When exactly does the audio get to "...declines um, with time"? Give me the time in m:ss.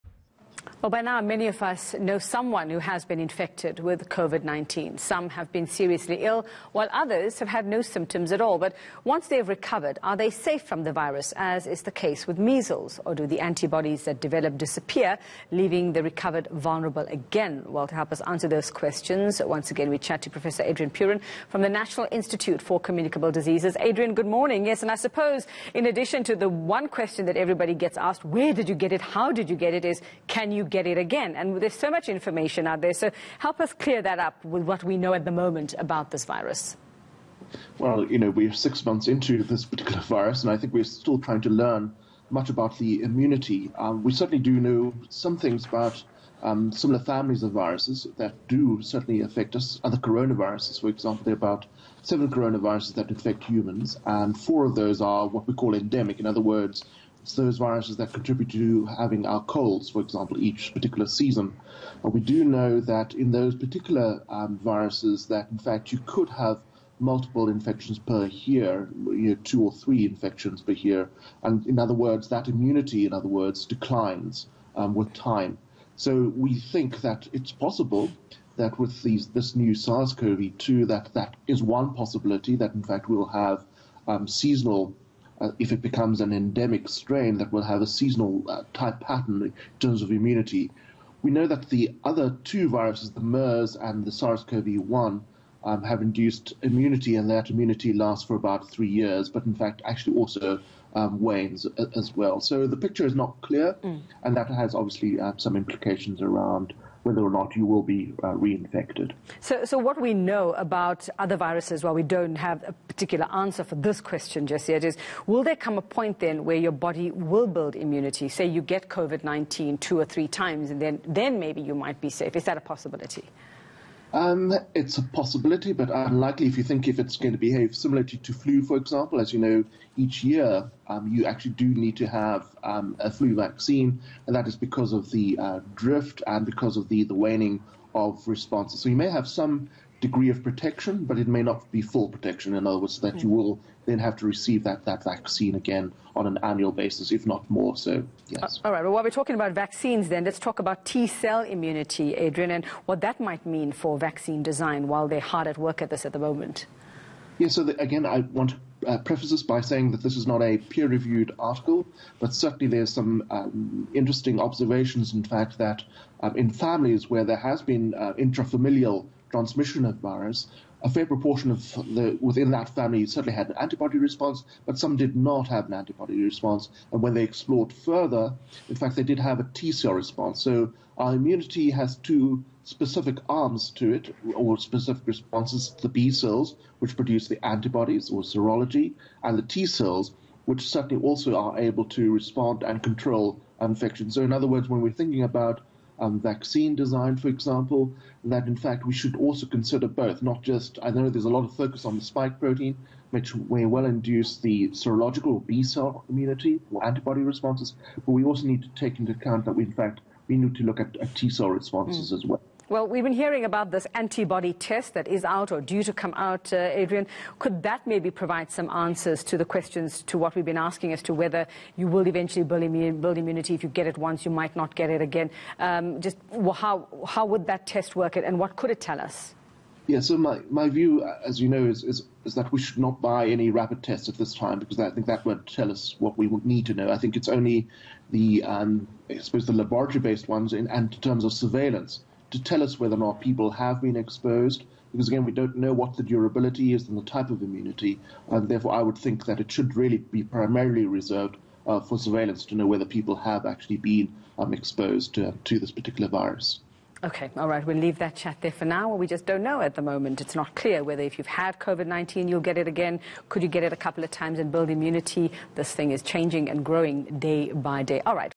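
1:13.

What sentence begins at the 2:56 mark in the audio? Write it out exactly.
And when they explored further, in fact, they did have a T cell response.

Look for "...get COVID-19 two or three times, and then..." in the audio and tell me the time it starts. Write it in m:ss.
1:58.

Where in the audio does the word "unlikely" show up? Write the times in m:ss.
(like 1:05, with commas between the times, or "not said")
2:05.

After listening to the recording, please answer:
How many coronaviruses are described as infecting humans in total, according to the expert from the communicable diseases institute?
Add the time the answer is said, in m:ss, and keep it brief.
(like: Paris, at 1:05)
7, at 0:52.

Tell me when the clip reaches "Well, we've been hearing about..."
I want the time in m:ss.
3:32.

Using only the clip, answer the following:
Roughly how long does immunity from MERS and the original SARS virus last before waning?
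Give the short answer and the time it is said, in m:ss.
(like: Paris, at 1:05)
3 years, at 1:38.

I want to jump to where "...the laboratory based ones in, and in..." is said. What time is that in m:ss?
3:59.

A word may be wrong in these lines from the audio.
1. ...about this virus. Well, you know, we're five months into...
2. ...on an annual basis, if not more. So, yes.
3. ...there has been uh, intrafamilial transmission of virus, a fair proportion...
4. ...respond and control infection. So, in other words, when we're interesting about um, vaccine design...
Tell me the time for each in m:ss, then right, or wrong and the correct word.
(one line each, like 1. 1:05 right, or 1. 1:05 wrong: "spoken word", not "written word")
1. 0:35 wrong: "six", not "five"
2. 2:26 right
3. 2:47 right
4. 3:12 wrong: "thinking", not "interesting".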